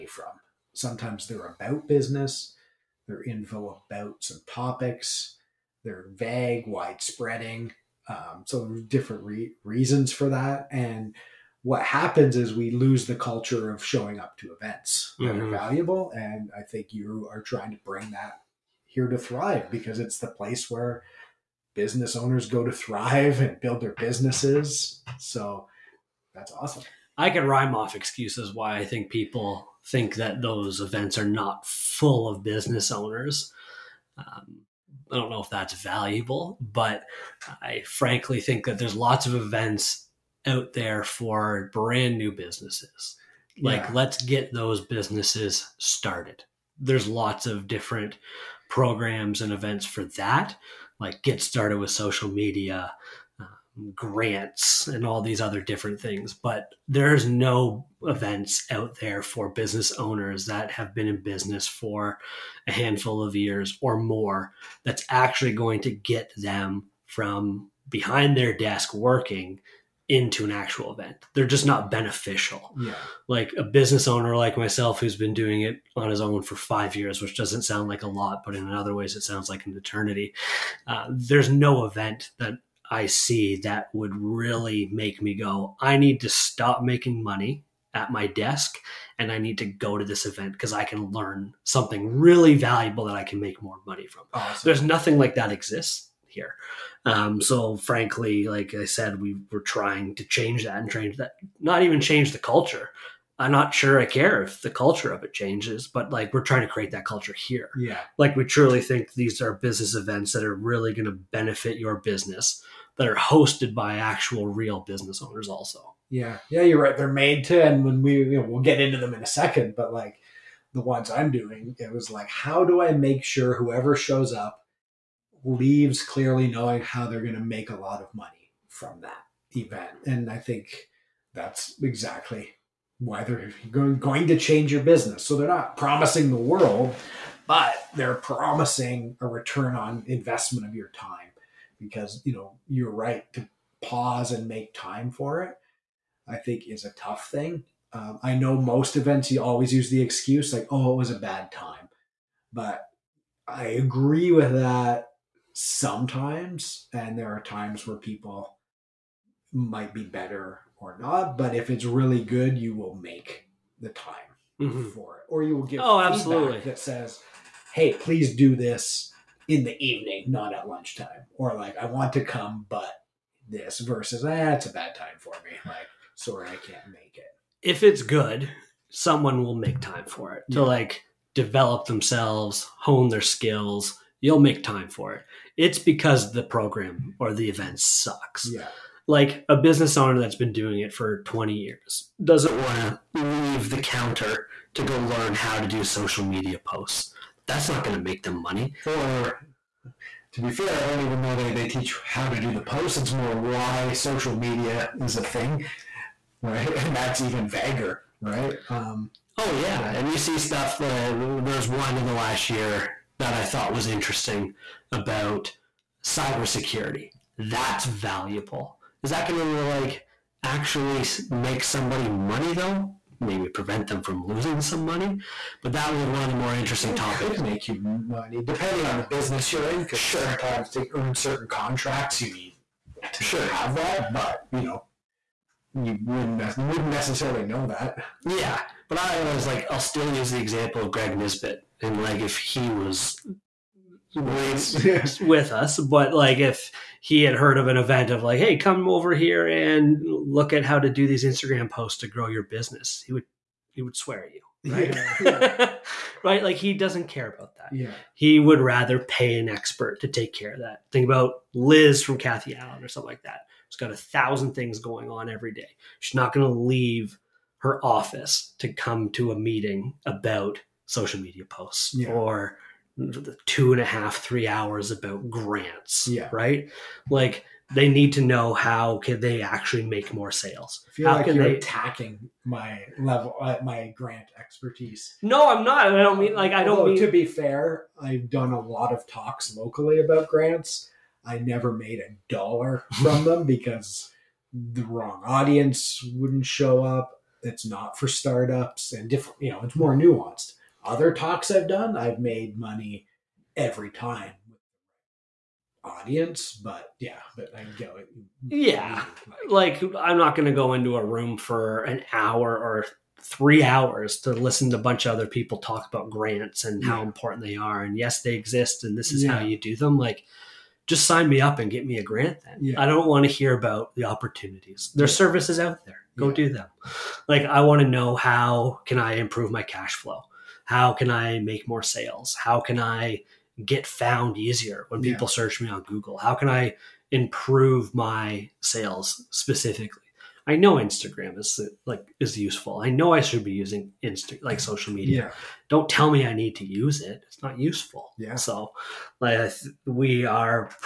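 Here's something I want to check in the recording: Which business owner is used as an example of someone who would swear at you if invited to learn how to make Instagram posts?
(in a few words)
Greg Nisbet.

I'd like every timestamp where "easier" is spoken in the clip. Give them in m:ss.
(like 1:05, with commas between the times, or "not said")
5:34.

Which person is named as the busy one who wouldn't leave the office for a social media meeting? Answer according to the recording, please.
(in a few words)
Kathy Allen.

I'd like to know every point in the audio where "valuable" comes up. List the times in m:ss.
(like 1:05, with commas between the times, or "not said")
0:15, 0:35, 1:32, 3:37.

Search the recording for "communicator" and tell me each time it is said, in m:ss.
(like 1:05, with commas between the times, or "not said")
not said.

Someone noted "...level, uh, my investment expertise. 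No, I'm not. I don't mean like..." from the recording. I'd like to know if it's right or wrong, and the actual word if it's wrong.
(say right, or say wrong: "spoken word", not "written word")
wrong: "grant", not "investment".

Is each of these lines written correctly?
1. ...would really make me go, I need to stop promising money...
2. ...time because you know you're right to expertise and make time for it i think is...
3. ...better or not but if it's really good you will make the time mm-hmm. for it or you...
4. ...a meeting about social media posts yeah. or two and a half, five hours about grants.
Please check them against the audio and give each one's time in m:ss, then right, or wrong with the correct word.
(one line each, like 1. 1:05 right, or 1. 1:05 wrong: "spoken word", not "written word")
1. 1:23 wrong: "making", not "promising"
2. 2:20 wrong: "pause", not "expertise"
3. 2:40 right
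4. 4:29 wrong: "three", not "five".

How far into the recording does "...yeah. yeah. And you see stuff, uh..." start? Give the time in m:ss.
3:29.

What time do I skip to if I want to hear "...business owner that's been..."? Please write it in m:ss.
3:09.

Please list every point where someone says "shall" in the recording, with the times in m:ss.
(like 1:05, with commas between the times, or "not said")
not said.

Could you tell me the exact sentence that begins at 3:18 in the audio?
Or to be fair, I don't even know they, they teach how to do the posts.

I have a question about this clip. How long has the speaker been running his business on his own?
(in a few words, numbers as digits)
5 years.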